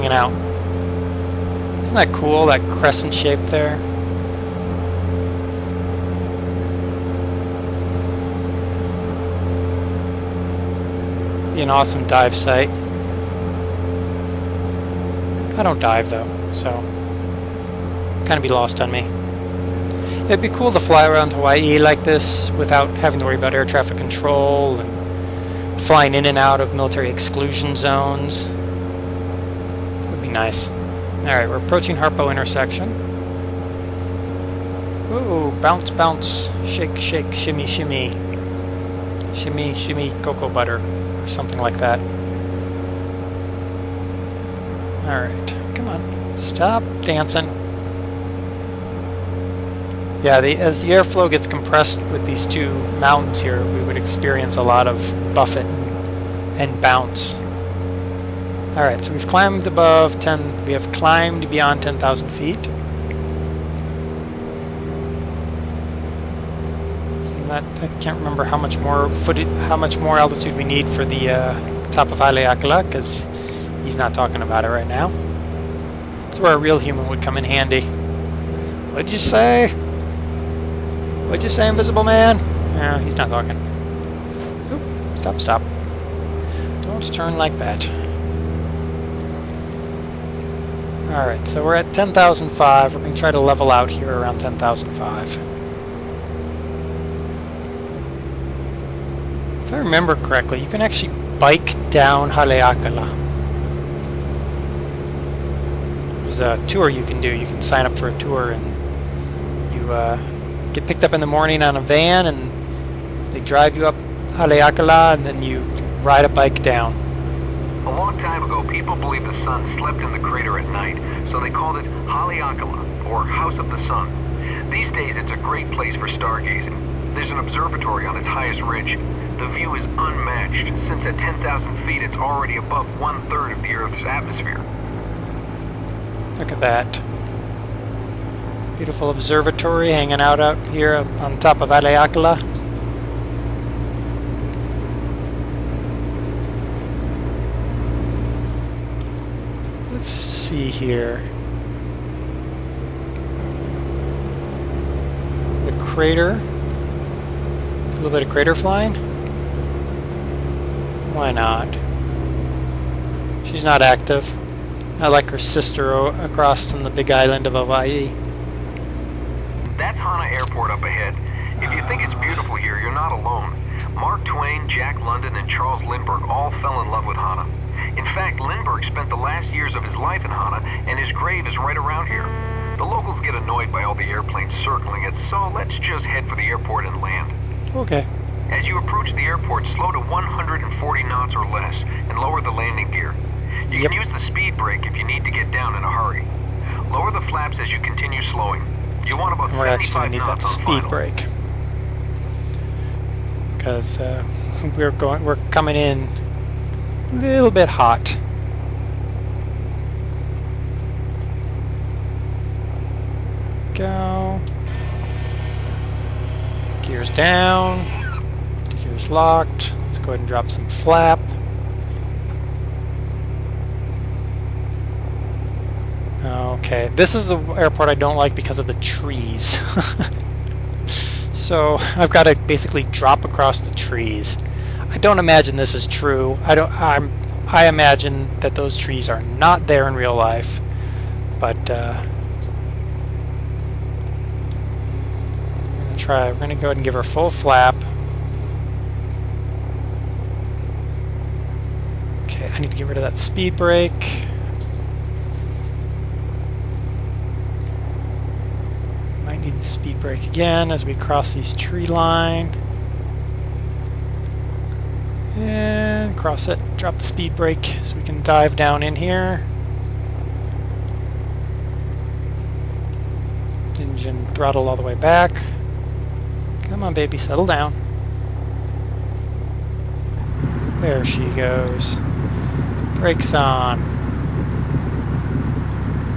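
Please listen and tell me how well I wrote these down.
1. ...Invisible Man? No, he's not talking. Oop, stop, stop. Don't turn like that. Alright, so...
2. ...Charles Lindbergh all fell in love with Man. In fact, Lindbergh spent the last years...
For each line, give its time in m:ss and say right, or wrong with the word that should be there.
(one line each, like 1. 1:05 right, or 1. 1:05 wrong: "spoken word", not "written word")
1. 1:21 right
2. 2:55 wrong: "Hana", not "Man".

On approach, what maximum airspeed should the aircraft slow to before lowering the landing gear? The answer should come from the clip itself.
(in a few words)
140 knots.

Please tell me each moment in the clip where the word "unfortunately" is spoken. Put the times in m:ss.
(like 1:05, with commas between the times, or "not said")
not said.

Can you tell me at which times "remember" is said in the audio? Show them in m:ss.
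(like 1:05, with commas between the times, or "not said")
1:08, 1:39.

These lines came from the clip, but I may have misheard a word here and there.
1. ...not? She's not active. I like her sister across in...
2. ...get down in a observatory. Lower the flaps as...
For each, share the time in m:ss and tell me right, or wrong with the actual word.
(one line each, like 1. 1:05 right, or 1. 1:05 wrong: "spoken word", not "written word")
1. 2:41 right
2. 3:15 wrong: "hurry", not "observatory".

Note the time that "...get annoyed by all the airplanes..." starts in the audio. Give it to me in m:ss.
3:03.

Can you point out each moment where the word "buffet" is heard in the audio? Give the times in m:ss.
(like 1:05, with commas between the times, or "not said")
0:55.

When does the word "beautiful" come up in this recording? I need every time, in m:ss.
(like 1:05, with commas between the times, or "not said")
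2:18, 2:52.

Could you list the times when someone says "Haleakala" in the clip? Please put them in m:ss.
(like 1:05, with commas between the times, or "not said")
1:12, 1:42, 1:54, 2:02, 2:21.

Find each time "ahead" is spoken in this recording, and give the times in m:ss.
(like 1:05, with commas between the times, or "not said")
2:50, 3:40, 4:06.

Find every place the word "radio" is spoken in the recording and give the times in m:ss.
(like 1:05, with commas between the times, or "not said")
not said.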